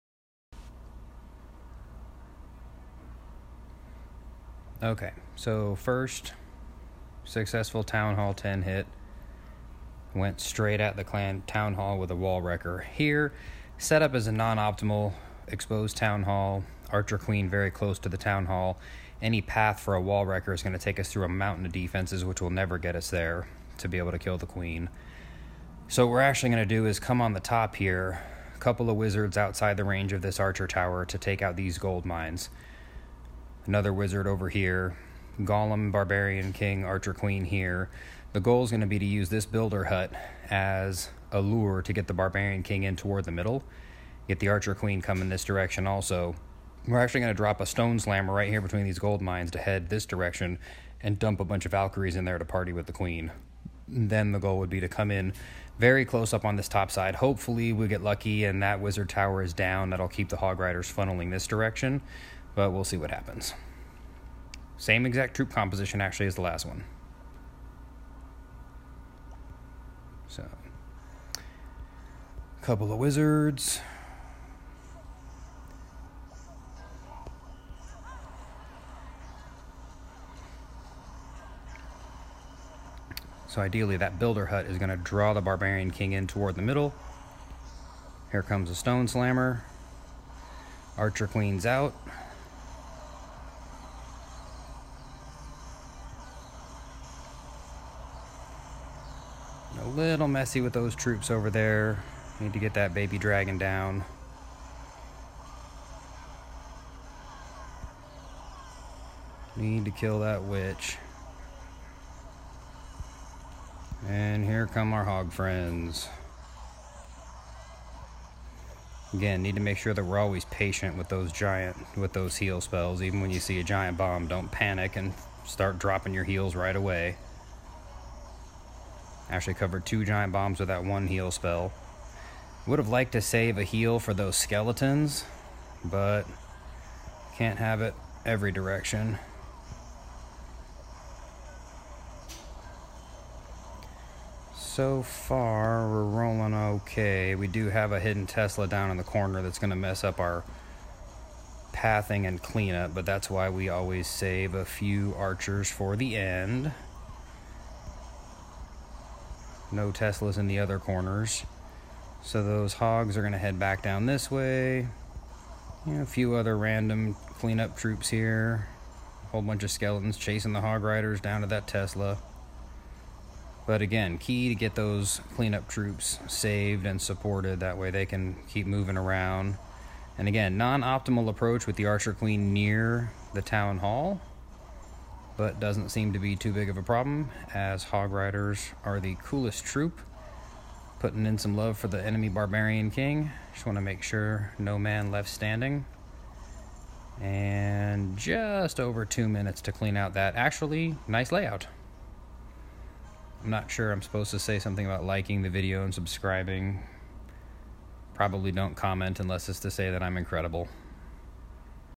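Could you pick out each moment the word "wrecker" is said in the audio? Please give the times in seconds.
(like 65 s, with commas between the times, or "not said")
12 s, 20 s.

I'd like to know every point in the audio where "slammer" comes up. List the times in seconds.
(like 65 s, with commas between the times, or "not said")
47 s, 89 s.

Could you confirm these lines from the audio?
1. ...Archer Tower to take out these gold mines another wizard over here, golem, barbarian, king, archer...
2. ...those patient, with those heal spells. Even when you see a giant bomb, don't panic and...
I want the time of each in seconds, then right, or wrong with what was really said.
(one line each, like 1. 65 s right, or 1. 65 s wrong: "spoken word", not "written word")
1. 30 s right
2. 121 s wrong: "giant", not "patient".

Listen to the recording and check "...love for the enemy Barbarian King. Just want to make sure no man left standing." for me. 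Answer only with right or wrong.
right.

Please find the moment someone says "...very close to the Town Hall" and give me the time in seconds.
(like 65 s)
17 s.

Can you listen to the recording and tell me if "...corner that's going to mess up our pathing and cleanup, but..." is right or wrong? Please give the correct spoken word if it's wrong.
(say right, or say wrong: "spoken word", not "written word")
right.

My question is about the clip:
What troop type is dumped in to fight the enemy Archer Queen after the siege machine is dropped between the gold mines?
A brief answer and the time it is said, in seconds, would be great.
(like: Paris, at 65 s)
Valkyries, at 51 s.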